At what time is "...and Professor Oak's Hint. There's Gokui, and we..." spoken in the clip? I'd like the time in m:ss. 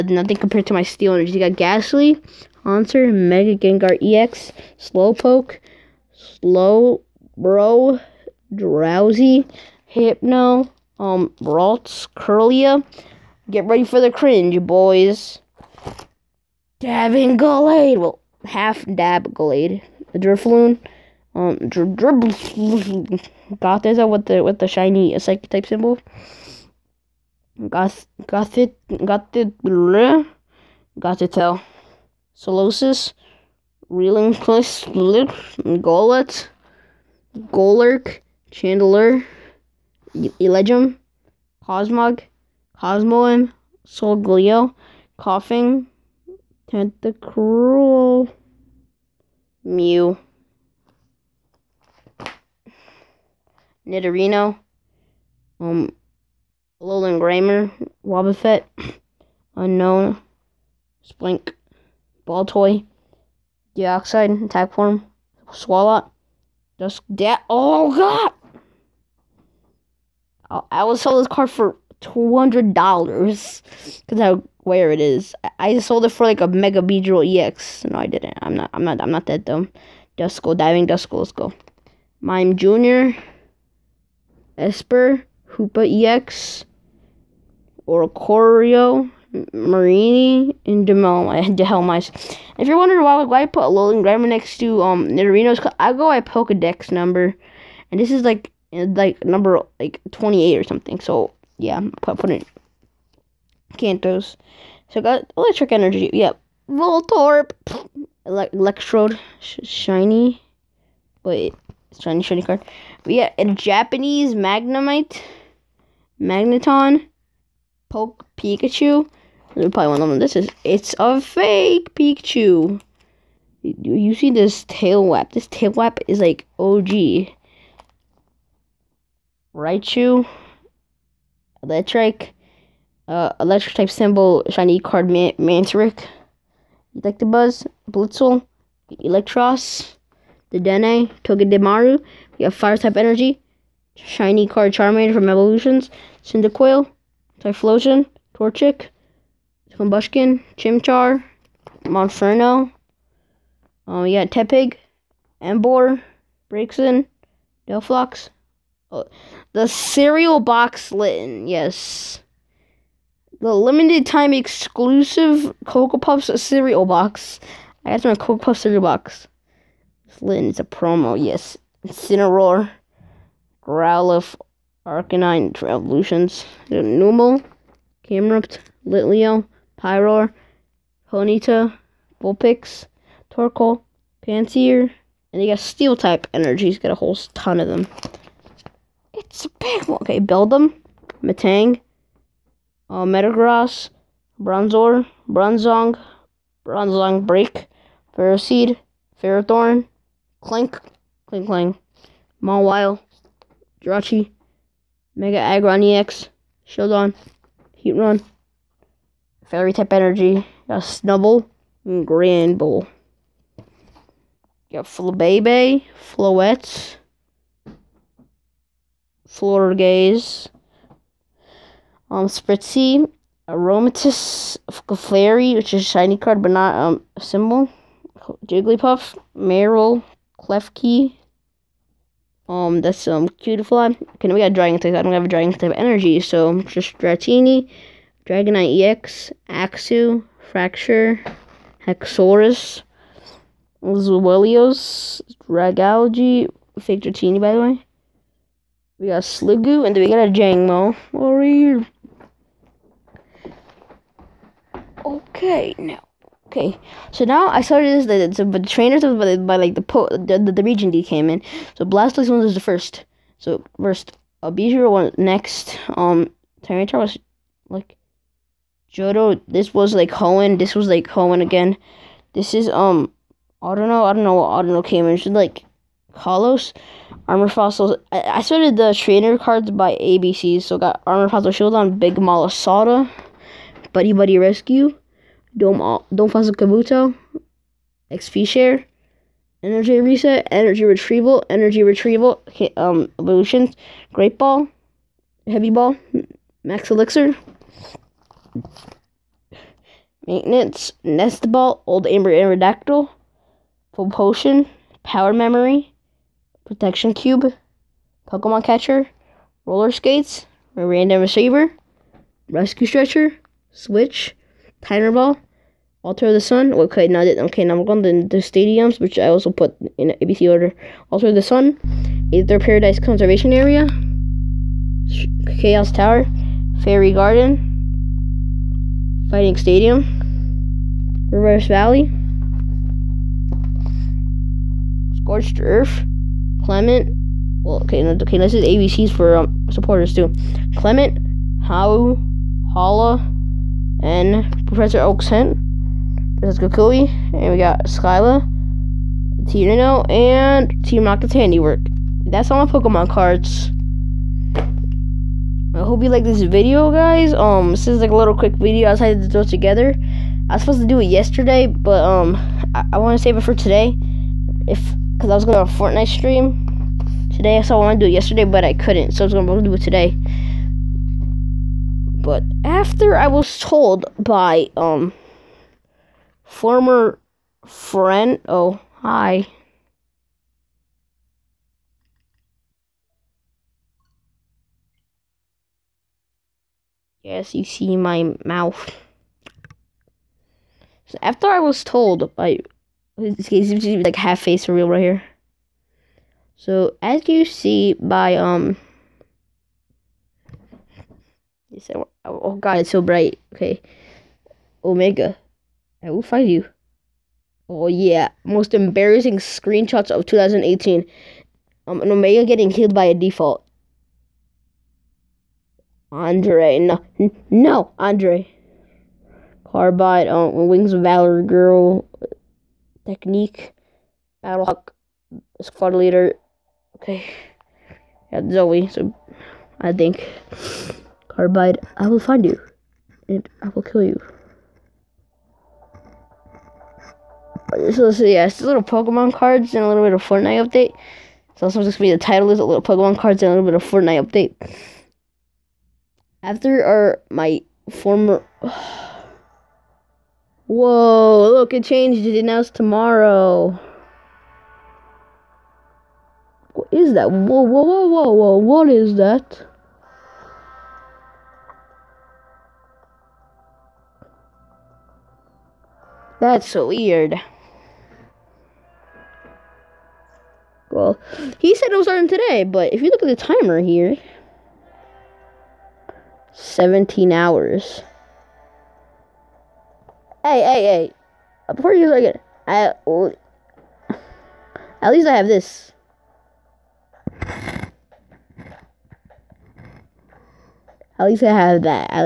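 5:43.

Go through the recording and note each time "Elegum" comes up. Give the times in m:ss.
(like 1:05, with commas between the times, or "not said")
0:40.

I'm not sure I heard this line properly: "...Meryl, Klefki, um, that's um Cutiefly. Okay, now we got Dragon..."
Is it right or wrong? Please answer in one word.
right.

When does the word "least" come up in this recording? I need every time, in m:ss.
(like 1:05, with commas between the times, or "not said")
8:05, 8:11.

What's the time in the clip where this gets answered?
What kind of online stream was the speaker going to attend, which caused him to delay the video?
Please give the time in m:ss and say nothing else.
6:05.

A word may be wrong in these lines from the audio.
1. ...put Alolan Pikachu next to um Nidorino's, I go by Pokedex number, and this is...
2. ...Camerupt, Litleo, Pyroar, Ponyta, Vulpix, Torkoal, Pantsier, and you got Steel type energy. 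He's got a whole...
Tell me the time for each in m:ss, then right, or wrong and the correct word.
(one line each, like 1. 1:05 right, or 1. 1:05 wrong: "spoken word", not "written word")
1. 1:33 wrong: "Grimer", not "Pikachu"
2. 2:58 right.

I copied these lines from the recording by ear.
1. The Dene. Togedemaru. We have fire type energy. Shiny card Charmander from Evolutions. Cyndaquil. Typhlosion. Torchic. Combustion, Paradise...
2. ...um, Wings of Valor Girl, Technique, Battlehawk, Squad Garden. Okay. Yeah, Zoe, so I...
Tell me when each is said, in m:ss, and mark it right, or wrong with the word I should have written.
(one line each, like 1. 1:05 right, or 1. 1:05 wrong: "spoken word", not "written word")
1. 2:20 wrong: "Chimchar", not "Paradise"
2. 7:00 wrong: "Leader", not "Garden".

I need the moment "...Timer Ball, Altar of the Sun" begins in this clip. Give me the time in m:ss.
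5:14.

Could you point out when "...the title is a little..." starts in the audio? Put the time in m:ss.
7:22.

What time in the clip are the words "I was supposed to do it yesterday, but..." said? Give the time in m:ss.
6:00.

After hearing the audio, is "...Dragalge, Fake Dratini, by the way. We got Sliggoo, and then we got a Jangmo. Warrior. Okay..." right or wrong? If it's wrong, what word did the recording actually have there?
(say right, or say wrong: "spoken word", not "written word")
right.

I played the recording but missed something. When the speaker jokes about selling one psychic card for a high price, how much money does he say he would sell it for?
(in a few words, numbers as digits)
$200.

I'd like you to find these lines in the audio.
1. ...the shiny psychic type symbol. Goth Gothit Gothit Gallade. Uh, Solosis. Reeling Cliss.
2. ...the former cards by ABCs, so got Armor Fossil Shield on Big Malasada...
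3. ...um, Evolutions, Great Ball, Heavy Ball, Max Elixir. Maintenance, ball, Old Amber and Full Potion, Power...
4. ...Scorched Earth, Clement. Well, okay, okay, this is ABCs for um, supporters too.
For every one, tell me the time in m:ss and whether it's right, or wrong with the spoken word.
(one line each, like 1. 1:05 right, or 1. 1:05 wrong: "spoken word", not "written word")
1. 0:24 wrong: "Gothitelle", not "Gallade"
2. 4:38 wrong: "trainer", not "former"
3. 4:52 right
4. 5:35 right.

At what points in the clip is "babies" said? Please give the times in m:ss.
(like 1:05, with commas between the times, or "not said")
not said.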